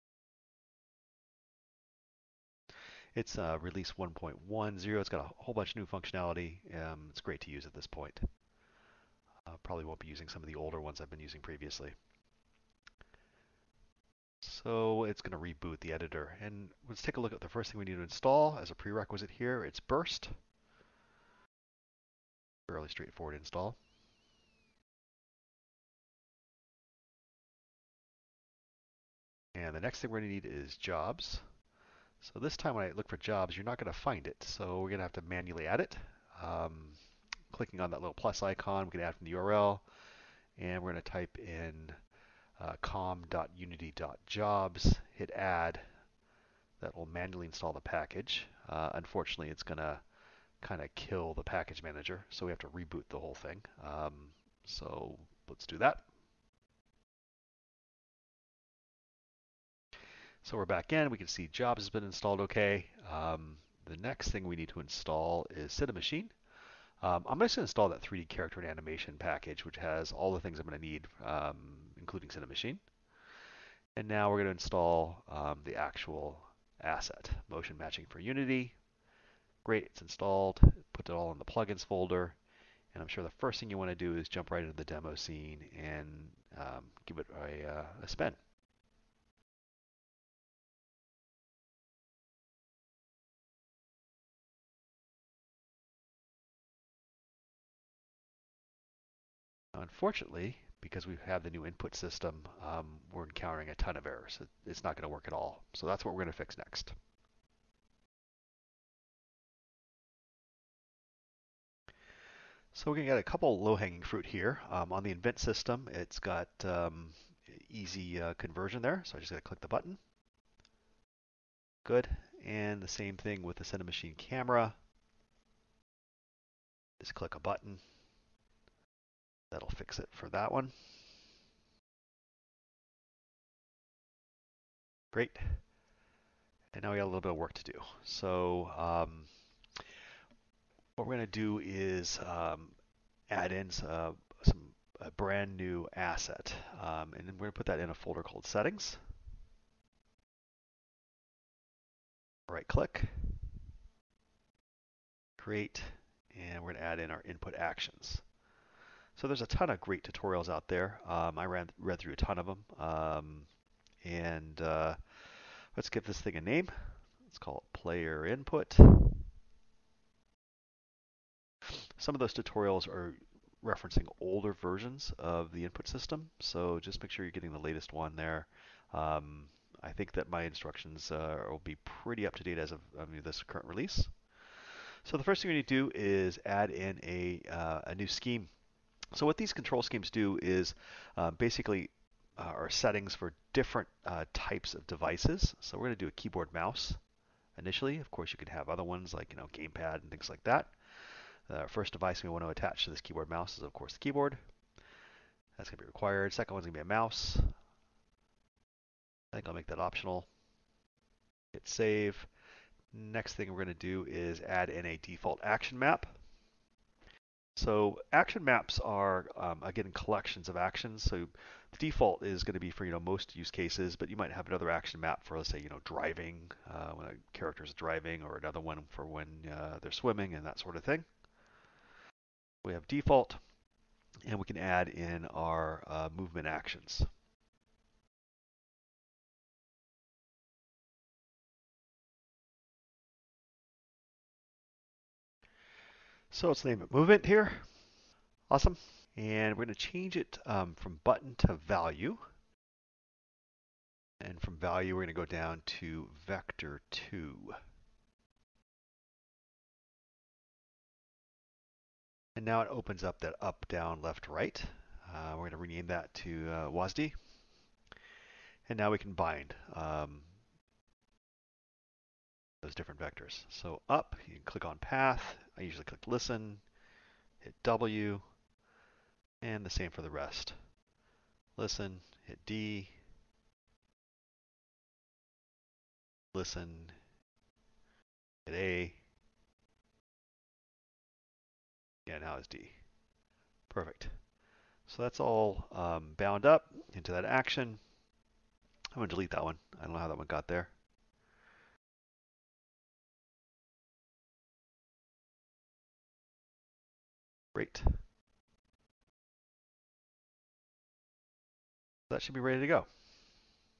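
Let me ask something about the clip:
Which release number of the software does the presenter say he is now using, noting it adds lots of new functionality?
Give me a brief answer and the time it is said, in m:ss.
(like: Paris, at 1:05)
1.10, at 0:03.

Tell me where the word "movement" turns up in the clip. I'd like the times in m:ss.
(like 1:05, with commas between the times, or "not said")
3:56, 4:06.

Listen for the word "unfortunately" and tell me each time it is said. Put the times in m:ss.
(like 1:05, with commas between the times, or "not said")
0:48, 1:39.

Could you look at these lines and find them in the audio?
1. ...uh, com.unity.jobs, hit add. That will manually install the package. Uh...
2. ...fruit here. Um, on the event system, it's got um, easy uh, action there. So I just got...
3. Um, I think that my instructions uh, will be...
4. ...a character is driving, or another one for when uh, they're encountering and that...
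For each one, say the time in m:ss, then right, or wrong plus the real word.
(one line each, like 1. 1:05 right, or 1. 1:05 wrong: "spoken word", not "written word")
1. 0:42 right
2. 1:54 wrong: "conversion", not "action"
3. 2:58 right
4. 3:47 wrong: "swimming", not "encountering".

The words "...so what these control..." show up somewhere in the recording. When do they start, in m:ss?
3:09.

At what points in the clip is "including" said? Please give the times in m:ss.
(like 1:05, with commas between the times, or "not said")
1:11.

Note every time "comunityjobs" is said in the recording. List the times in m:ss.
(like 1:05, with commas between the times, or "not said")
0:42.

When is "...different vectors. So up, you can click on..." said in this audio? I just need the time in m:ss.
4:32.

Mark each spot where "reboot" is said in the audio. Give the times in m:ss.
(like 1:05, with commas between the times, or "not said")
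0:15, 0:52.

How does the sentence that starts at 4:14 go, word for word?
And from value, we're going to go down to vector 2.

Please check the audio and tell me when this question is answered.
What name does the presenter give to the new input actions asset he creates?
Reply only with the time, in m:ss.
2:47.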